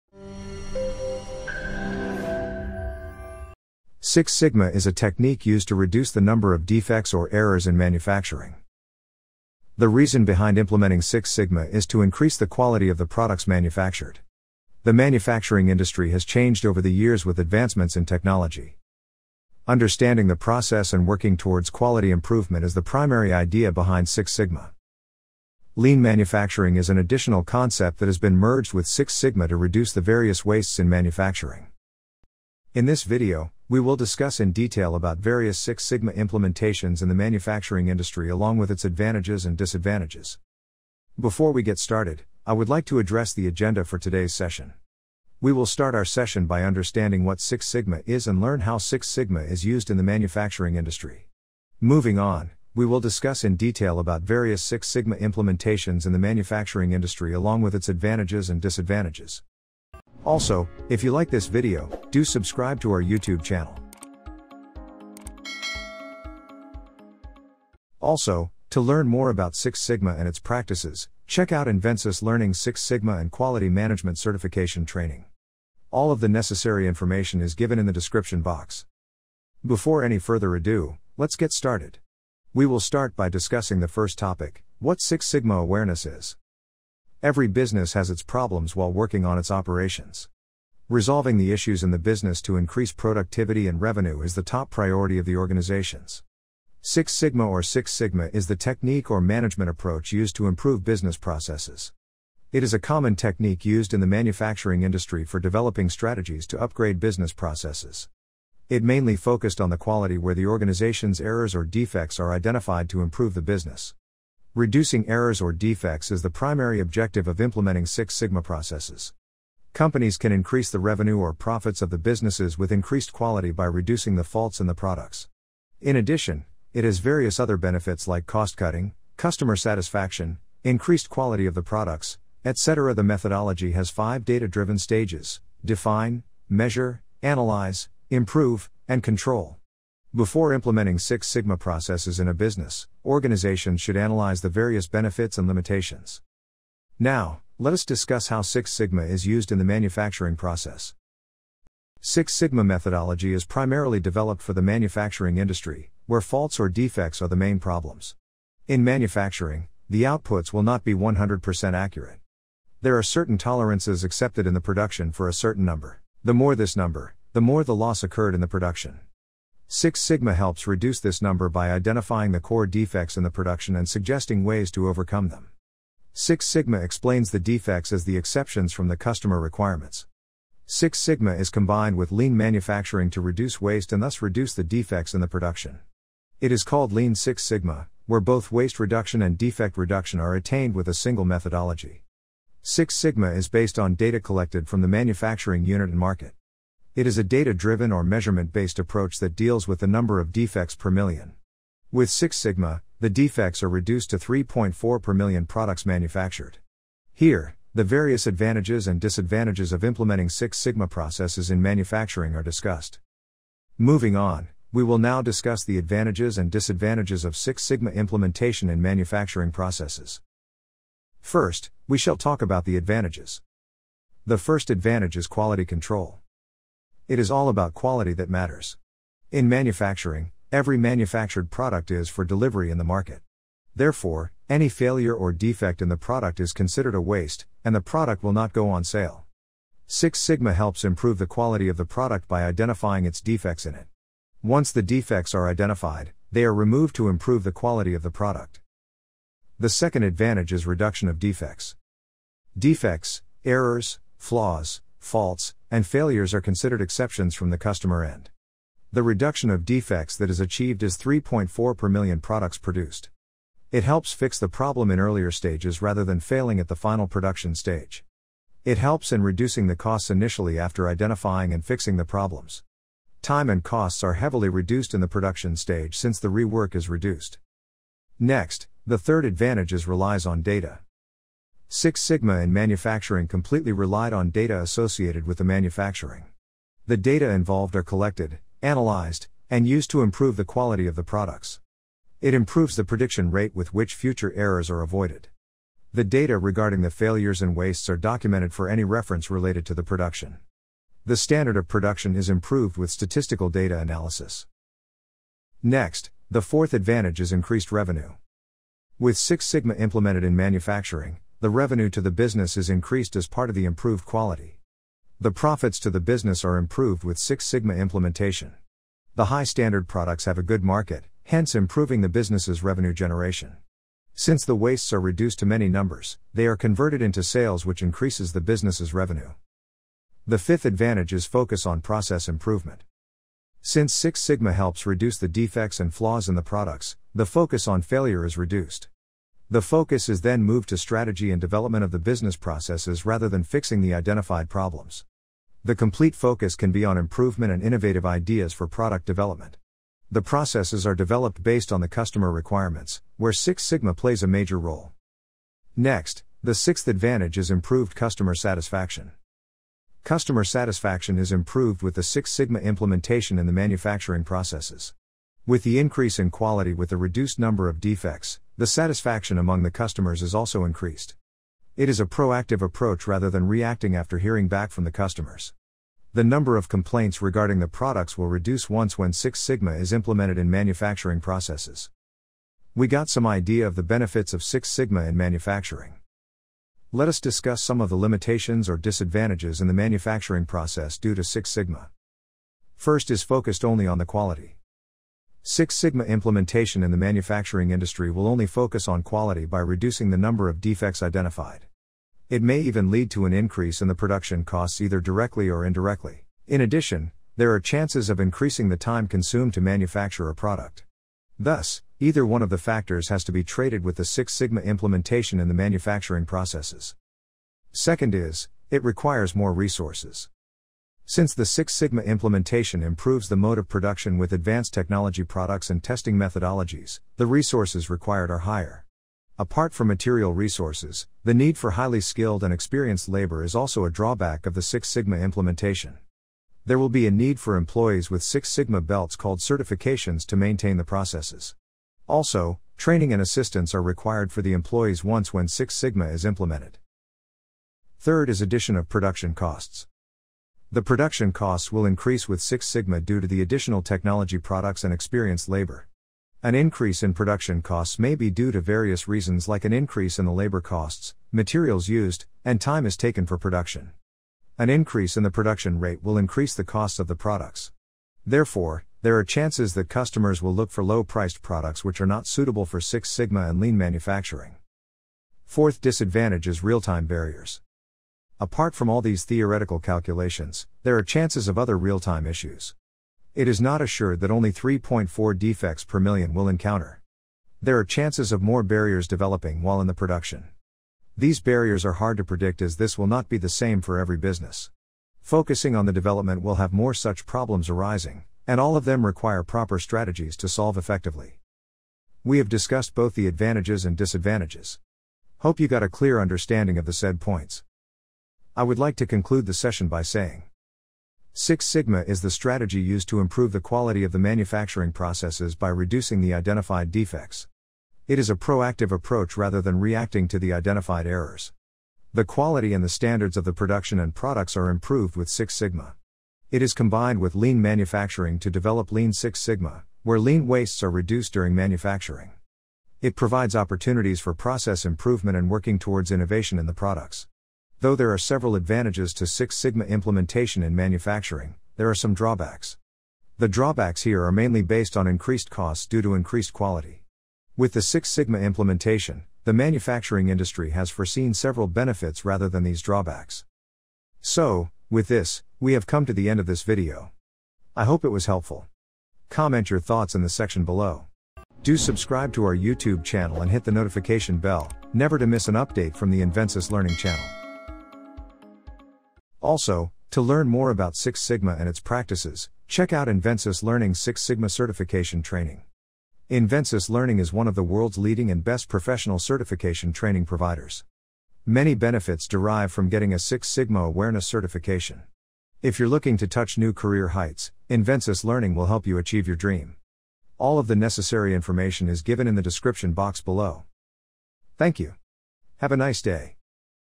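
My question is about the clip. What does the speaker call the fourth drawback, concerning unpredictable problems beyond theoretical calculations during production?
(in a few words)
real time barriers.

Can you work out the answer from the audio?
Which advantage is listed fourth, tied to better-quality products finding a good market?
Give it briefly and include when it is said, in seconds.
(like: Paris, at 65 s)
increased revenue, at 307 s.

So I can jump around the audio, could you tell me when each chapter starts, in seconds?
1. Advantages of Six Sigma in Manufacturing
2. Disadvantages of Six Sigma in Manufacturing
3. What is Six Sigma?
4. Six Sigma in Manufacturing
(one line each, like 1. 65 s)
1. 221 s
2. 388 s
3. 80 s
4. 148 s.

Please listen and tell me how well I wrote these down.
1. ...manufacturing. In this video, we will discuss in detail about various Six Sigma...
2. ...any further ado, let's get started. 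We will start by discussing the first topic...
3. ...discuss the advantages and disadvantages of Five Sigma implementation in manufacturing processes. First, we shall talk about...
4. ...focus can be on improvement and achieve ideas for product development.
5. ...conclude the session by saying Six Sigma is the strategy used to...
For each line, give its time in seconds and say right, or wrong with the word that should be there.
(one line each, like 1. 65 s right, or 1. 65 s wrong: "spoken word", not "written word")
1. 30 s right
2. 80 s right
3. 215 s wrong: "Six", not "Five"
4. 346 s wrong: "innovative", not "achieve"
5. 509 s right.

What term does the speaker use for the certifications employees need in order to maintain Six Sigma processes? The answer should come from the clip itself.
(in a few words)
Six Sigma belts.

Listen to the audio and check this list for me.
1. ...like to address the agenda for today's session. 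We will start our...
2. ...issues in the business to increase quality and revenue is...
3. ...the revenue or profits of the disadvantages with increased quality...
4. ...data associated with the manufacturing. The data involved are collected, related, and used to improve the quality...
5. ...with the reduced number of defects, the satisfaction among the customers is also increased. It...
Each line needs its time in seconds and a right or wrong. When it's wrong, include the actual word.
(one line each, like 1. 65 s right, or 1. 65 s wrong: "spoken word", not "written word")
1. 42 s right
2. 91 s wrong: "productivity", not "quality"
3. 120 s wrong: "businesses", not "disadvantages"
4. 284 s wrong: "analyzed", not "related"
5. 366 s right.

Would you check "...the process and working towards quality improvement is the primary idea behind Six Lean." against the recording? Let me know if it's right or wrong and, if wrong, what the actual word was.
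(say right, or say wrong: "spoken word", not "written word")
wrong: "Sigma", not "Lean".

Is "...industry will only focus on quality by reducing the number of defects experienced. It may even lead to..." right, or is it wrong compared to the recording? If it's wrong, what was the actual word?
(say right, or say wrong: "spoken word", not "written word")
wrong: "identified", not "experienced".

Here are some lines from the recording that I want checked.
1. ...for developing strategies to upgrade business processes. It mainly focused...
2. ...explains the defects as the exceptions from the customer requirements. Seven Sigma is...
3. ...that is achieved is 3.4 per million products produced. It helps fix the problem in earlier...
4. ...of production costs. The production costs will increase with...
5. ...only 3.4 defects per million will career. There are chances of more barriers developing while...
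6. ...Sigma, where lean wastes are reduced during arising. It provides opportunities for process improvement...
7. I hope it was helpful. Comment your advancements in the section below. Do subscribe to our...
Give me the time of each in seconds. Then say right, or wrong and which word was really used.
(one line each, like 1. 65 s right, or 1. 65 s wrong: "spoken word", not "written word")
1. 105 s right
2. 176 s wrong: "Six", not "Seven"
3. 260 s right
4. 448 s right
5. 484 s wrong: "encounter", not "career"
6. 529 s wrong: "manufacturing", not "arising"
7. 557 s wrong: "thoughts", not "advancements".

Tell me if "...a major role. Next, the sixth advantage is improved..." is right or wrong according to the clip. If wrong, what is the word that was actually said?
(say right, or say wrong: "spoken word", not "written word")
right.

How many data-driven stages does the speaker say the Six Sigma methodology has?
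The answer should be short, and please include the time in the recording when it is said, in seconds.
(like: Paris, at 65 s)
5, at 133 s.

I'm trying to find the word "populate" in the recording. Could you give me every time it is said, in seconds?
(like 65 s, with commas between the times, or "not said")
not said.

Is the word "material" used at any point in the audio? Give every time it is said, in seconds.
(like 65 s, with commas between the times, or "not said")
429 s, 461 s.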